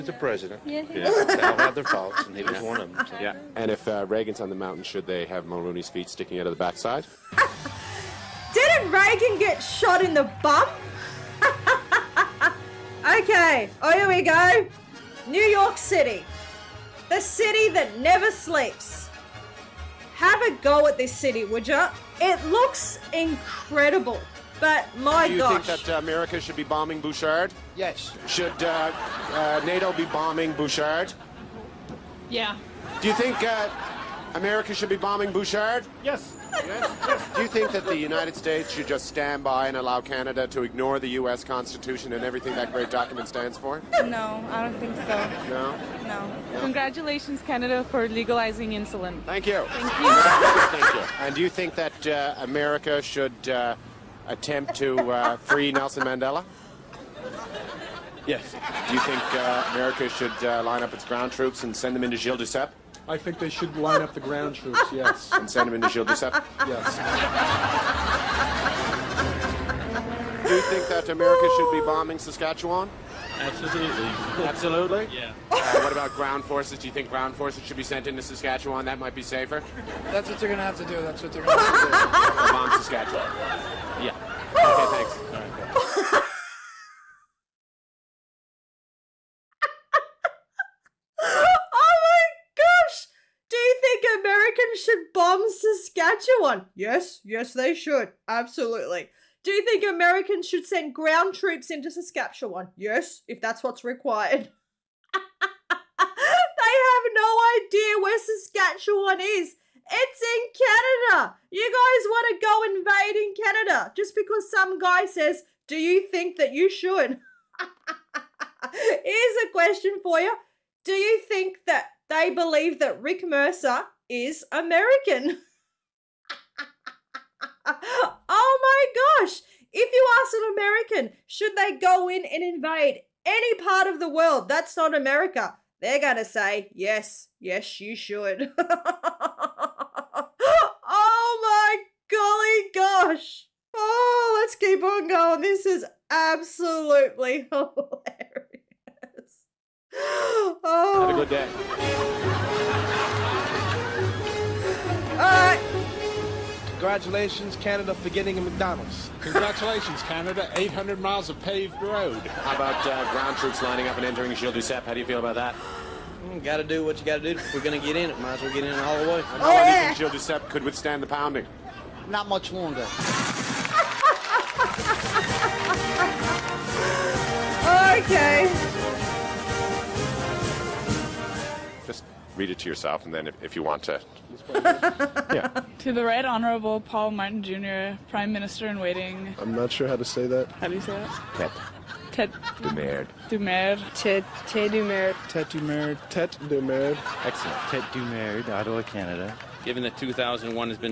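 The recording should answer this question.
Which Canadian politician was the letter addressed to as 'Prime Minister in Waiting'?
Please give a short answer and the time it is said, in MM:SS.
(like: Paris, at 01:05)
Paul Martin Jr., at 03:06.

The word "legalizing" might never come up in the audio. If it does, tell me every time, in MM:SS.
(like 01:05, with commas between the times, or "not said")
00:48.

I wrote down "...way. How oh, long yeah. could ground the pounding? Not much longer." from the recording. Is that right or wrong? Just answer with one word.
wrong.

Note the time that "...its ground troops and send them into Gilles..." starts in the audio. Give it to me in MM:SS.
01:00.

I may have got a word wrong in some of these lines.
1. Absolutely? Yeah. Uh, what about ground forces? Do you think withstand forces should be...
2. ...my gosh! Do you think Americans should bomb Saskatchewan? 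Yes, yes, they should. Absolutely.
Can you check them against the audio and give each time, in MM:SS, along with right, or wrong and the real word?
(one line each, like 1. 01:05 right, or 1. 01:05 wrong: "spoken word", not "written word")
1. 01:14 wrong: "ground", not "withstand"
2. 01:32 right.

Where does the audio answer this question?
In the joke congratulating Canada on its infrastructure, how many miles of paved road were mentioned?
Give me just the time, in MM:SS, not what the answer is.
02:40.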